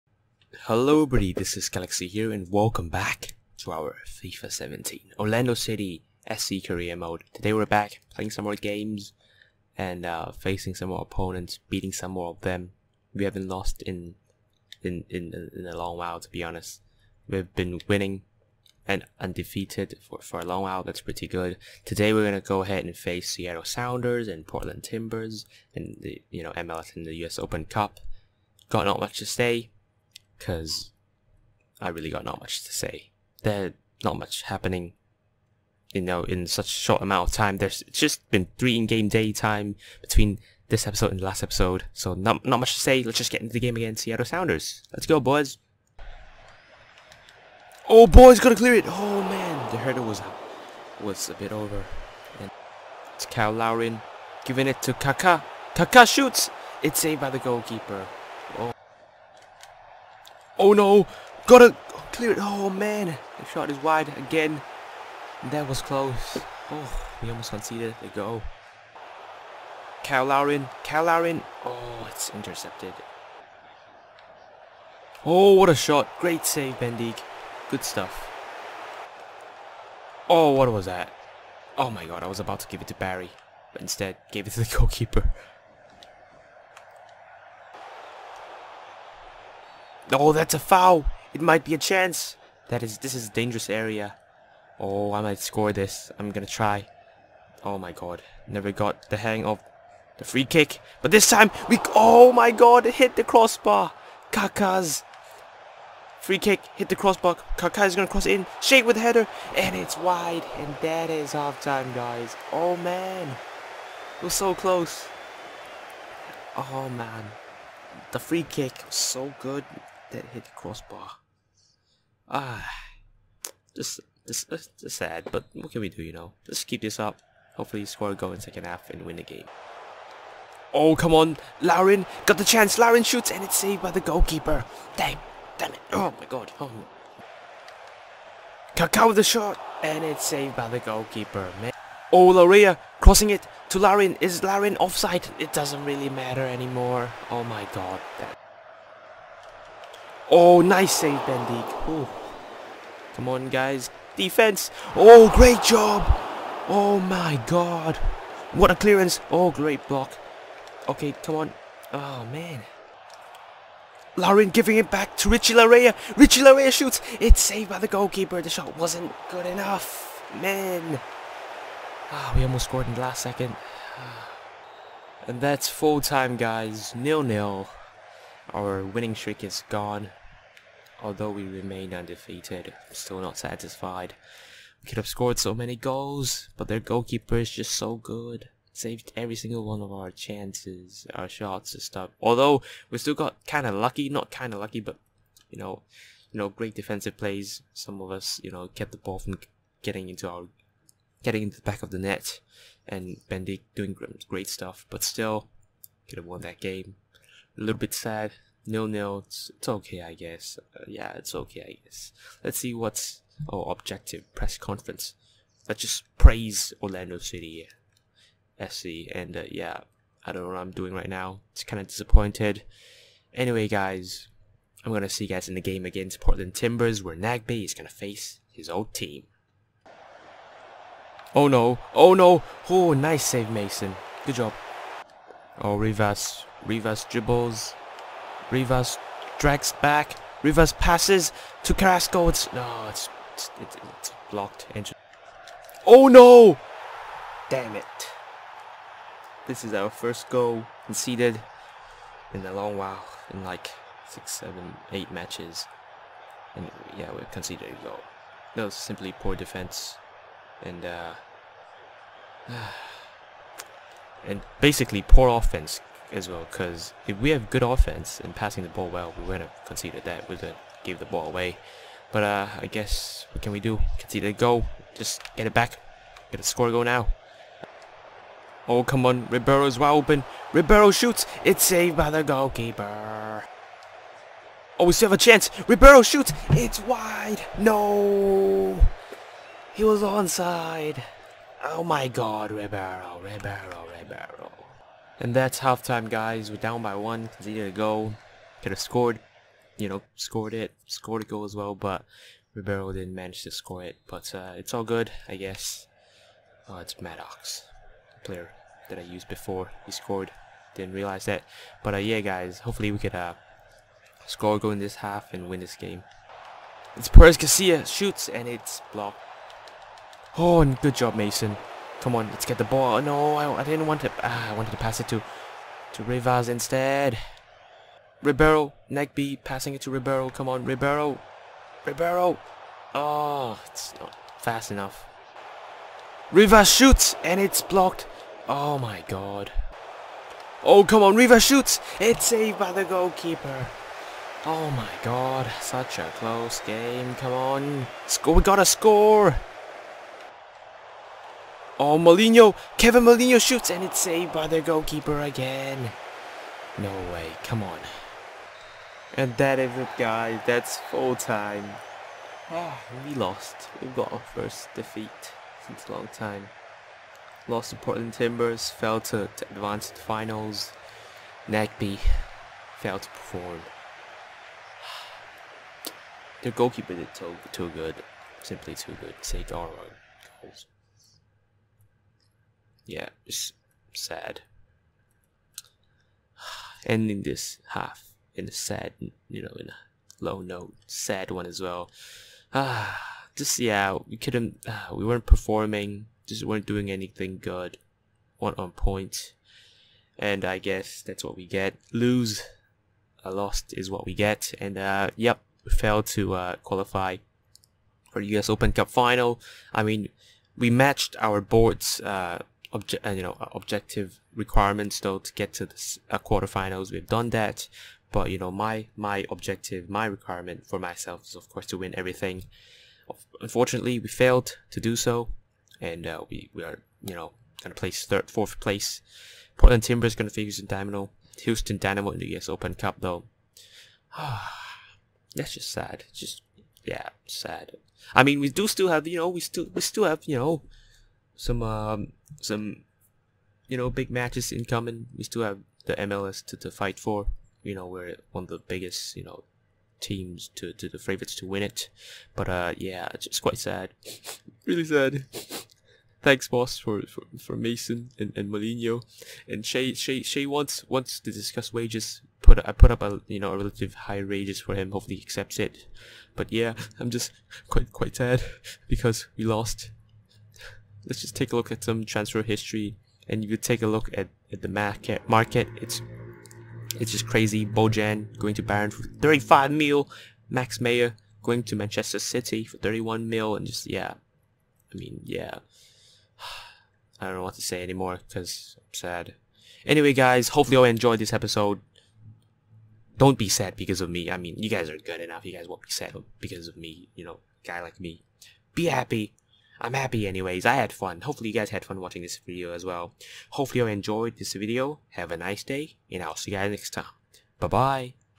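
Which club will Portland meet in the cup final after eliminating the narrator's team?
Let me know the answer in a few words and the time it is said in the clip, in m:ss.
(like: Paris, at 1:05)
Houston Dynamo, at 7:11.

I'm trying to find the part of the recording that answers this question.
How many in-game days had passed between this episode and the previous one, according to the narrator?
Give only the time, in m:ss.
0:38.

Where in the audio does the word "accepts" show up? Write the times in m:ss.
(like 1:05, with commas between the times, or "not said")
7:45.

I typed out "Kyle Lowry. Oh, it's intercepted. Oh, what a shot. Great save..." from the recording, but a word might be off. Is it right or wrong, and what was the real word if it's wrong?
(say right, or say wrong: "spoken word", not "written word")
right.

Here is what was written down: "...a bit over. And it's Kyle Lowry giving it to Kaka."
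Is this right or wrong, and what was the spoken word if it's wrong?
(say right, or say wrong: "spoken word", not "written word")
right.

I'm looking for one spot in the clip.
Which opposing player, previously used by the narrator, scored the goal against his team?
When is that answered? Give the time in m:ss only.
5:06.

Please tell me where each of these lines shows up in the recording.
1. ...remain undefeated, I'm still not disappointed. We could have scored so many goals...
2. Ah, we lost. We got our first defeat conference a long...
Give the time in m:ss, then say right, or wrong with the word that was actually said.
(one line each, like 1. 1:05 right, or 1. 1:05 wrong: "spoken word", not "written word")
1. 3:01 wrong: "satisfied", not "disappointed"
2. 6:02 wrong: "since", not "conference".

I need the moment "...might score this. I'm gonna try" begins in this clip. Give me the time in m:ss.
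1:35.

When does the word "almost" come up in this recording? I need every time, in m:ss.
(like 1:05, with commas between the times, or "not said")
1:07, 2:52.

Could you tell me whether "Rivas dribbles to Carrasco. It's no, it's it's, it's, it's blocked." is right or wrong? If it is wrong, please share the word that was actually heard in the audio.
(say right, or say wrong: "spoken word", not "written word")
wrong: "passes", not "dribbles".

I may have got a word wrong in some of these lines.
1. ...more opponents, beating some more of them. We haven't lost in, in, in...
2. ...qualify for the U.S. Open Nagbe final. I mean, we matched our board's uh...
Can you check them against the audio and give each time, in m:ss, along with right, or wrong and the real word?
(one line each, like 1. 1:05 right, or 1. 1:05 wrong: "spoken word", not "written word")
1. 0:10 right
2. 6:46 wrong: "Cup", not "Nagbe".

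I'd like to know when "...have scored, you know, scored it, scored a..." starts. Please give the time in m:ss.
4:58.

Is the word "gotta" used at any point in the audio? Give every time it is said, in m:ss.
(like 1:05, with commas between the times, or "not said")
1:01, 5:48.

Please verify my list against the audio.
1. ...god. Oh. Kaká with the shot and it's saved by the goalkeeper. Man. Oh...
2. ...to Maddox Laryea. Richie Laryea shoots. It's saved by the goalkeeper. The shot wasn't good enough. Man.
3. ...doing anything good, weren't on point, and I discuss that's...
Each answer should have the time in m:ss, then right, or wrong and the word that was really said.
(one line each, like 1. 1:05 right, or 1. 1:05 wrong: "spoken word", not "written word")
1. 2:16 right
2. 2:45 wrong: "Richie", not "Maddox"
3. 6:36 wrong: "guess", not "discuss".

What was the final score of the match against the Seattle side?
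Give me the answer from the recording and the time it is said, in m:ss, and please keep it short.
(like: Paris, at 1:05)
0-0, at 2:56.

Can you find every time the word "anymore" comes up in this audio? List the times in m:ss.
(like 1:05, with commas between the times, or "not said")
2:26, 8:07.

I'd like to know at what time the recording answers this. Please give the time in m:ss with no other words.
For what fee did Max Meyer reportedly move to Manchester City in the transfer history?
8:02.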